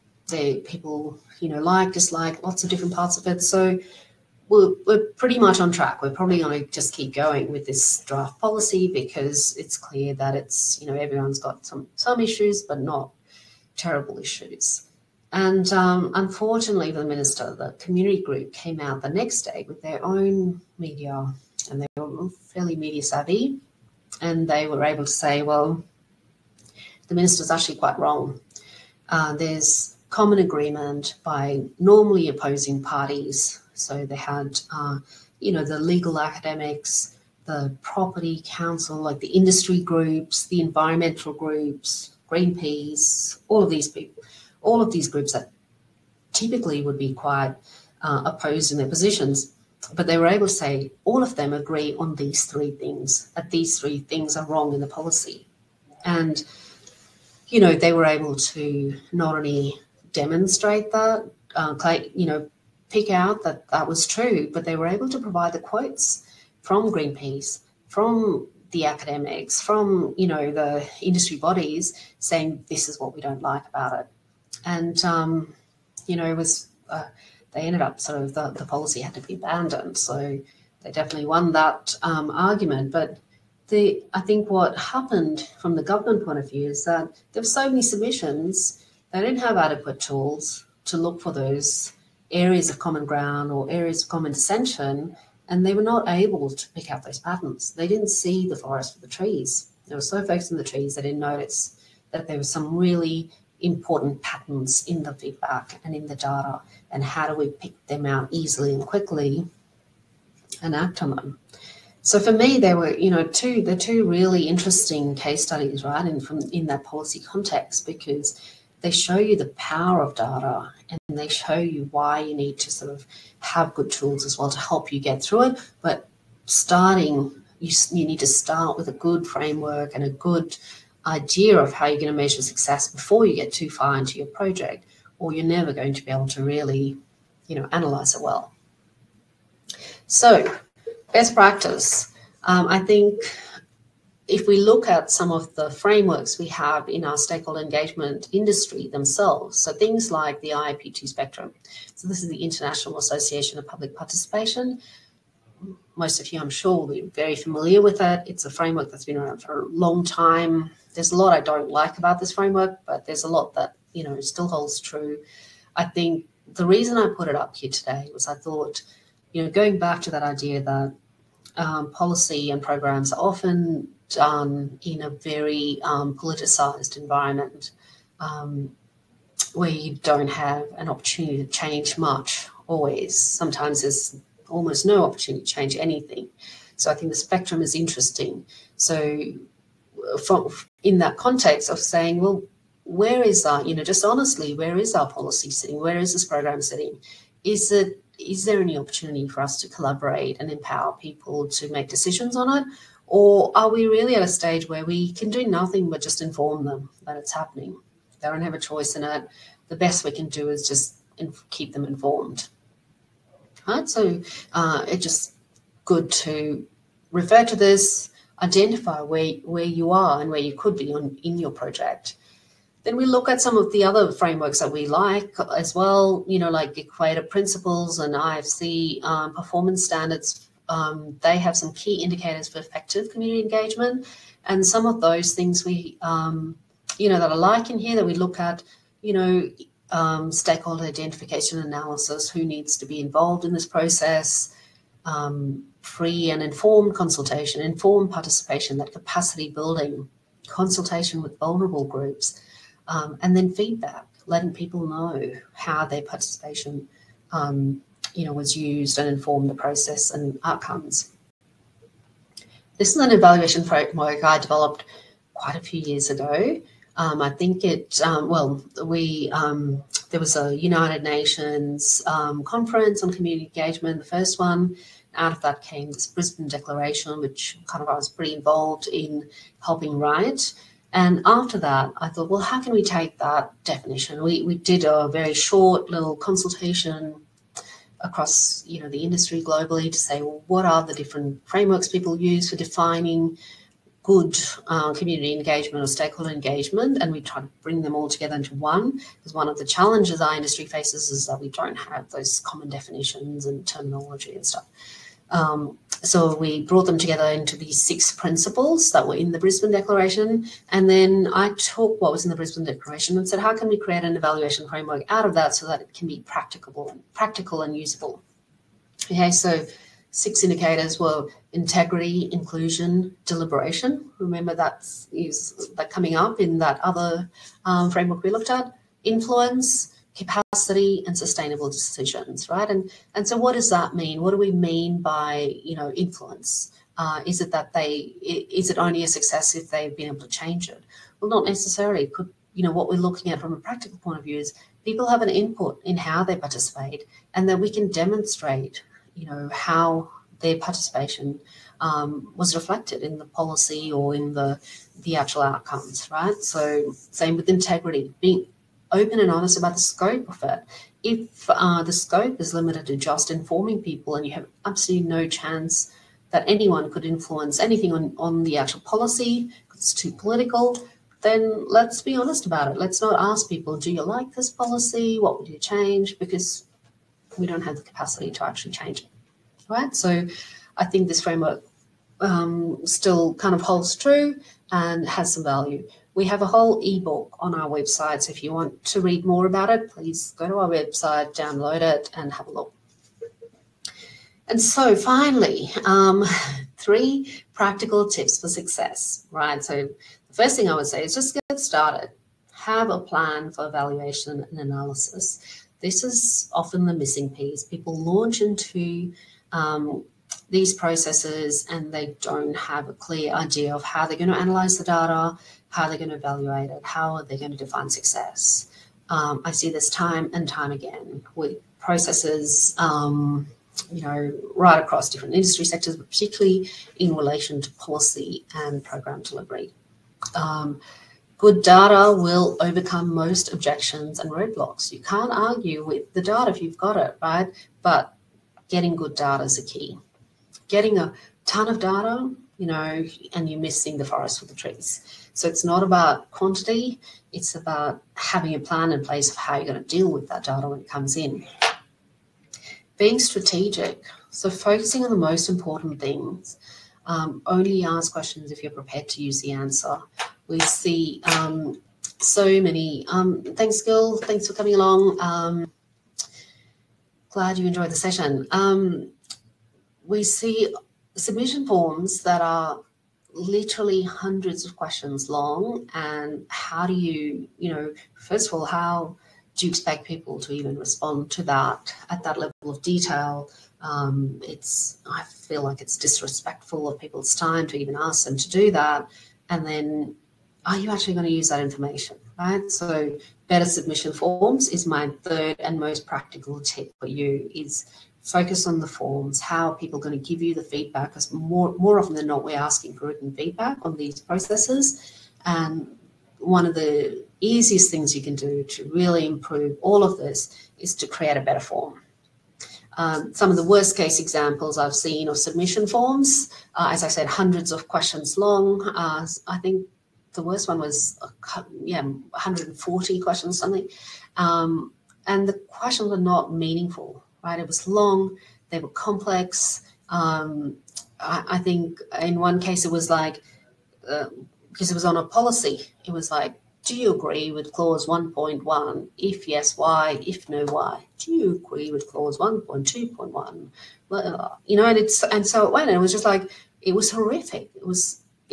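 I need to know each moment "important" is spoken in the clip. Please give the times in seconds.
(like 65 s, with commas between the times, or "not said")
103 s, 455 s.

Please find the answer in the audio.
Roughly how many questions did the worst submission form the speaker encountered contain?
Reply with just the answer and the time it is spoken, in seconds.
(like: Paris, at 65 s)
140, at 522 s.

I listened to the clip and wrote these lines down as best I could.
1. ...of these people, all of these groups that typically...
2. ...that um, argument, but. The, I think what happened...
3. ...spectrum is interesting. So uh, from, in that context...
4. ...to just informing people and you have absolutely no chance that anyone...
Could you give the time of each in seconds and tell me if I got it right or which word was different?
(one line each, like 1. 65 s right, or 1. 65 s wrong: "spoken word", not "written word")
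1. 43 s right
2. 81 s right
3. 187 s right
4. 362 s right.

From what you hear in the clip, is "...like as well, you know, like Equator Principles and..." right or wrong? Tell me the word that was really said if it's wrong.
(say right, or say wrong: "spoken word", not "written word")
right.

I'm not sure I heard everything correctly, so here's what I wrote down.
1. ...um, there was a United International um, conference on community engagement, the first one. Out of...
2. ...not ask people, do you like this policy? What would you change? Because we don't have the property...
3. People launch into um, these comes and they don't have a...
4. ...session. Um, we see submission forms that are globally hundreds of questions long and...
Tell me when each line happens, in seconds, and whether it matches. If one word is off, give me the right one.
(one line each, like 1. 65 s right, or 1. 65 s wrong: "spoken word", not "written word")
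1. 269 s wrong: "Nations", not "International"
2. 373 s wrong: "capacity", not "property"
3. 407 s wrong: "processes", not "comes"
4. 467 s wrong: "literally", not "globally".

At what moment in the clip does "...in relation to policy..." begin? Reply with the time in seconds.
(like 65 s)
426 s.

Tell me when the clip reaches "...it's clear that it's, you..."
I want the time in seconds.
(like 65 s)
9 s.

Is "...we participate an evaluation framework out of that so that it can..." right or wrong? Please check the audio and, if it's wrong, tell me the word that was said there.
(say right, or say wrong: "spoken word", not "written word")
wrong: "create", not "participate".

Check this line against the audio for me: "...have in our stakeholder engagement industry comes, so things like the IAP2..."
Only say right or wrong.
wrong.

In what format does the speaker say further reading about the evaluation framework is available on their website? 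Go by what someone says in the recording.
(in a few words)
Ebook.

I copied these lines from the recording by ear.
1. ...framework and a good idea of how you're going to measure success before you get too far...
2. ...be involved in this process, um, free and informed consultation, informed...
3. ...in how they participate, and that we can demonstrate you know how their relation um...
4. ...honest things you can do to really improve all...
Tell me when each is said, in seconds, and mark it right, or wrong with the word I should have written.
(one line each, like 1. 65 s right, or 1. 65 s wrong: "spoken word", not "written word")
1. 129 s right
2. 242 s right
3. 345 s wrong: "participation", not "relation"
4. 507 s wrong: "easiest", not "honest".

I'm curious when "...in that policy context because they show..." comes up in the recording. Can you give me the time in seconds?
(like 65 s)
116 s.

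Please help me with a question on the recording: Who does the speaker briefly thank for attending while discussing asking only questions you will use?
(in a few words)
Gil.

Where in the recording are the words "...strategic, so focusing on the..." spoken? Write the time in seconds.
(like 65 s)
453 s.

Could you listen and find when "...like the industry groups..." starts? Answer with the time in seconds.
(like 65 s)
38 s.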